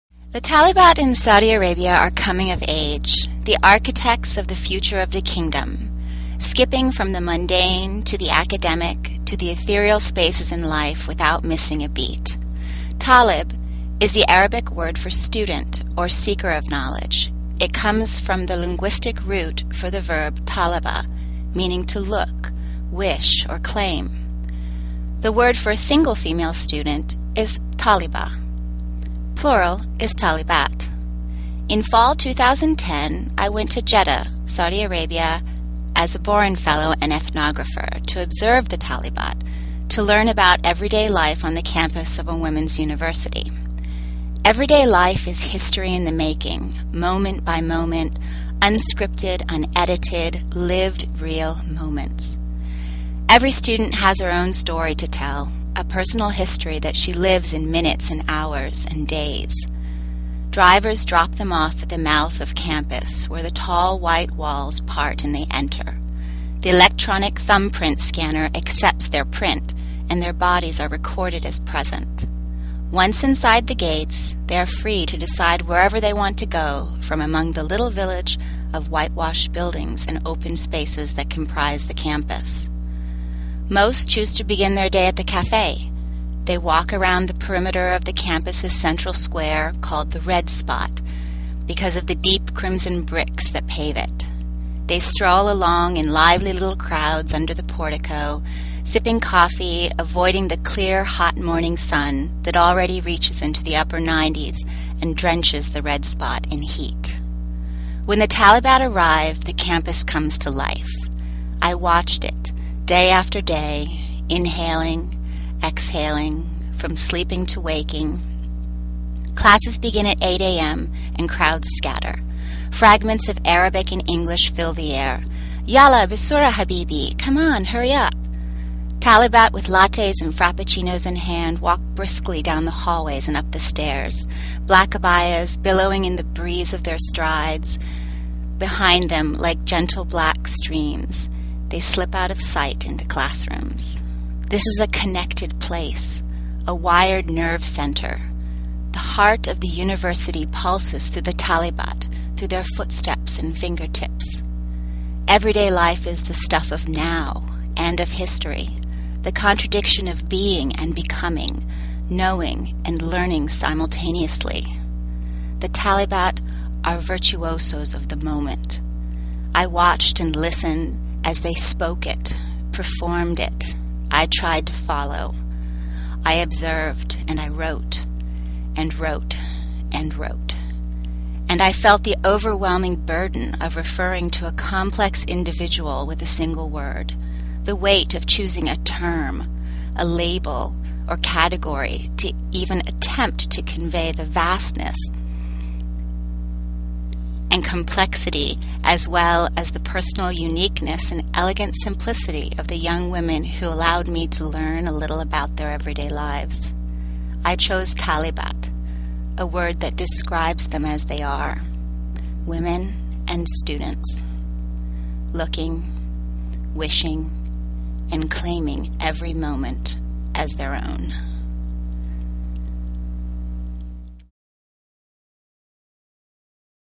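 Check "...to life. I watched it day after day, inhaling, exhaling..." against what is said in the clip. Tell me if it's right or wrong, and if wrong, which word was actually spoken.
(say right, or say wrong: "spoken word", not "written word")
right.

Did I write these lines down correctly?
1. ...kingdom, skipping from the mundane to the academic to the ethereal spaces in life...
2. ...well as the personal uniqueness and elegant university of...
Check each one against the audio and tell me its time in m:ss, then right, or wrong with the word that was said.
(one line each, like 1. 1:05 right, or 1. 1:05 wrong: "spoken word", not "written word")
1. 0:05 right
2. 3:19 wrong: "simplicity", not "university".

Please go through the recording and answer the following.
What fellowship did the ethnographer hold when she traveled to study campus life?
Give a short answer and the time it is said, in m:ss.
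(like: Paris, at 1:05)
Boren Fellow, at 0:36.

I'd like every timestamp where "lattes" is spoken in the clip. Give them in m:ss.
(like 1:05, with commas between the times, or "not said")
2:09.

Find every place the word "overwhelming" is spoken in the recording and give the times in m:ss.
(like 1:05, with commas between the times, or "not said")
3:02.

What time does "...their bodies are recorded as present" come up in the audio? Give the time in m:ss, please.
1:10.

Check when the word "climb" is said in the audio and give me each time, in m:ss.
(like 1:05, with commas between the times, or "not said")
not said.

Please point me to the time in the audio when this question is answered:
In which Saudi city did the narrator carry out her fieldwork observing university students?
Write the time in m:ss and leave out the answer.
0:33.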